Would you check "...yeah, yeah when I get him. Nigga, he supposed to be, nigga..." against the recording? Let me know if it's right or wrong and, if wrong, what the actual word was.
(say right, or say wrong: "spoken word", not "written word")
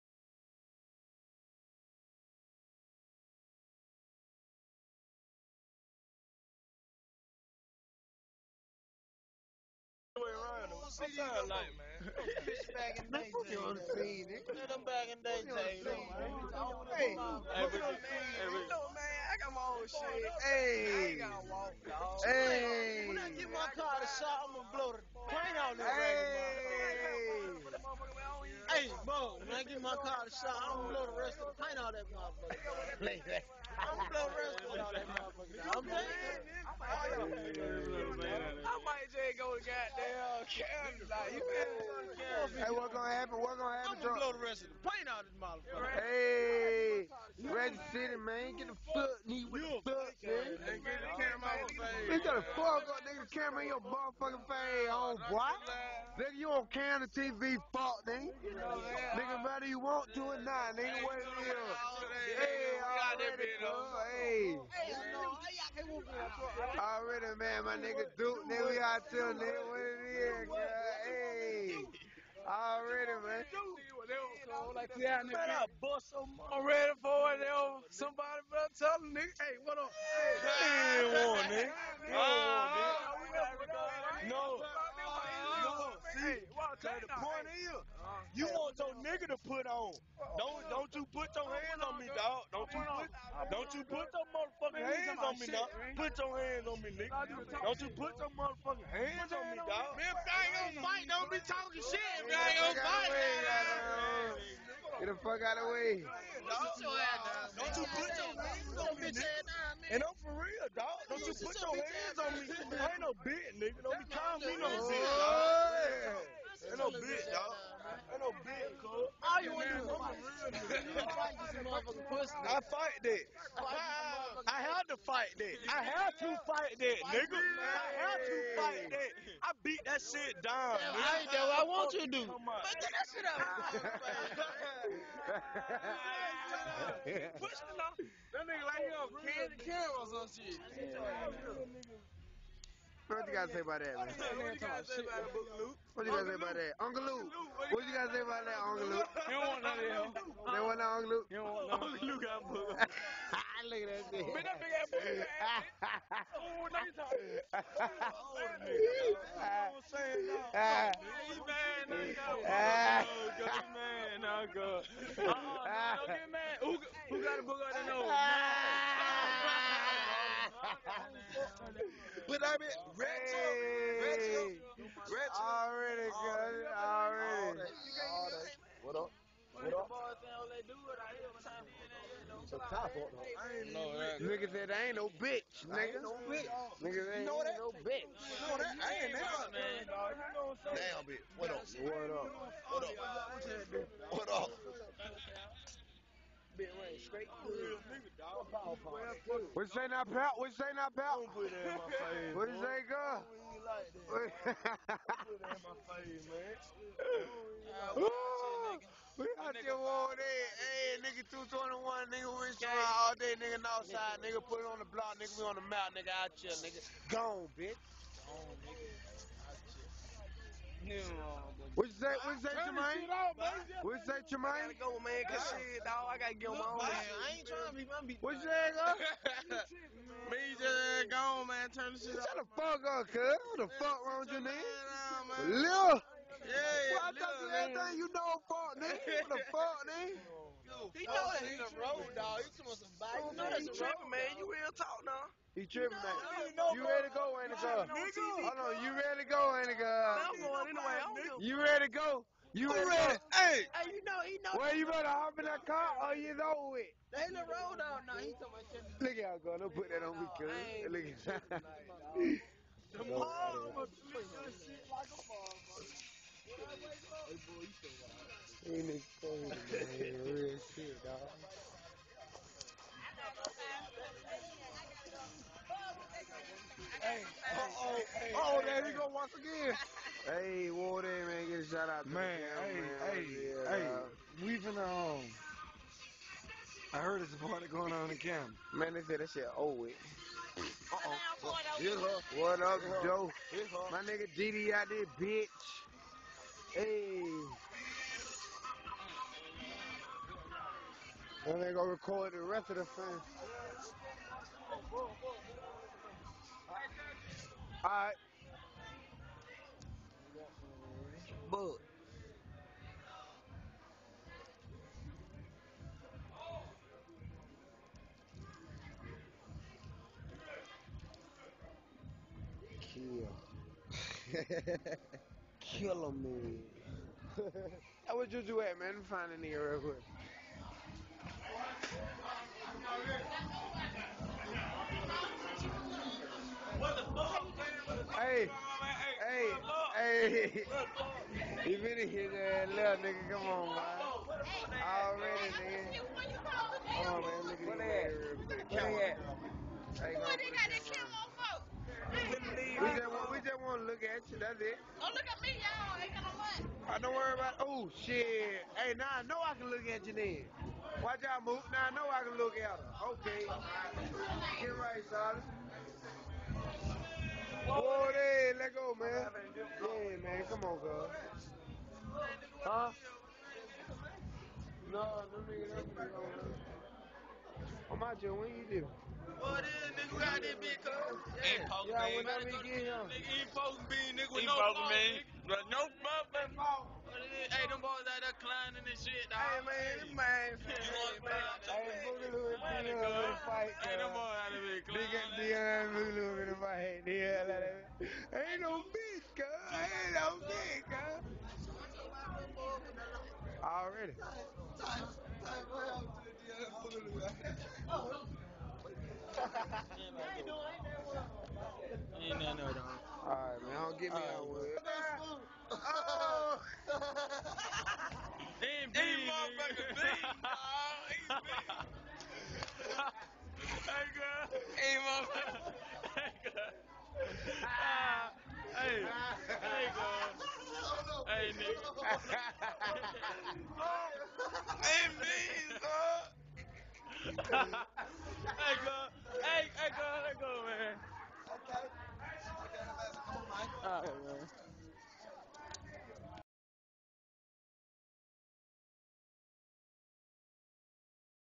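right.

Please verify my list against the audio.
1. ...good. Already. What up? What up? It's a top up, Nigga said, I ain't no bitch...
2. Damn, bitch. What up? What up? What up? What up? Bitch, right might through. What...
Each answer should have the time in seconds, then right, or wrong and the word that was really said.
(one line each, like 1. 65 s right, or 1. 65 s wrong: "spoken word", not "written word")
1. 176 s right
2. 190 s wrong: "straight", not "might".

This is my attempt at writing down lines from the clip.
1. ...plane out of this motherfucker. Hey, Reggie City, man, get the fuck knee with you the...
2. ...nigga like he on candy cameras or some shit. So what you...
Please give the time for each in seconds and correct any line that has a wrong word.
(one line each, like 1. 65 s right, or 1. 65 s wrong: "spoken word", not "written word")
1. 44 s right
2. 138 s right.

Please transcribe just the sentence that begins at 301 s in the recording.
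And they gonna record the rest of the fans.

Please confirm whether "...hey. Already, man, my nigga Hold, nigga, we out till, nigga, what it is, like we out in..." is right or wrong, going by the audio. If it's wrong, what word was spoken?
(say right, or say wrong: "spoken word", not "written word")
wrong: "Duke", not "Hold".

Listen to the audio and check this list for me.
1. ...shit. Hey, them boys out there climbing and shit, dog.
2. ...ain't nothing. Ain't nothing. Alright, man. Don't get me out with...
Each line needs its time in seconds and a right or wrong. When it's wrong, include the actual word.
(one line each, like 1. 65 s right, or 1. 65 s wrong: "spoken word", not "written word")
1. 387 s right
2. 410 s right.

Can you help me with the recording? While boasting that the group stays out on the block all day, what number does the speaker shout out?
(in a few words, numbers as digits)
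221.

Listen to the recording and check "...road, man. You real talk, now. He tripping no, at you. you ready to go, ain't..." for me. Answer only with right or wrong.
right.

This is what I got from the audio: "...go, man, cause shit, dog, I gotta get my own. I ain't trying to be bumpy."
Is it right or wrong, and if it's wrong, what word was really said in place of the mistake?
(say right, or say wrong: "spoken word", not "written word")
right.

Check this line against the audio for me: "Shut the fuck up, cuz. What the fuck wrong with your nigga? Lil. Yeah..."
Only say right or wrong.
right.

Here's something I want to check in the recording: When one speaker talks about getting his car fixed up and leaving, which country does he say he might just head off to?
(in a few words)
Canada.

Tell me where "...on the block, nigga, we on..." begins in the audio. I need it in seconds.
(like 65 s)
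214 s.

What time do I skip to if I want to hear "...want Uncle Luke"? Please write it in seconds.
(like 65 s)
151 s.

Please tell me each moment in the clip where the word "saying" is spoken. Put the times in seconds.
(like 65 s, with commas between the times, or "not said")
35 s, 159 s.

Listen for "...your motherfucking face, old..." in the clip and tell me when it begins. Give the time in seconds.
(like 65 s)
53 s.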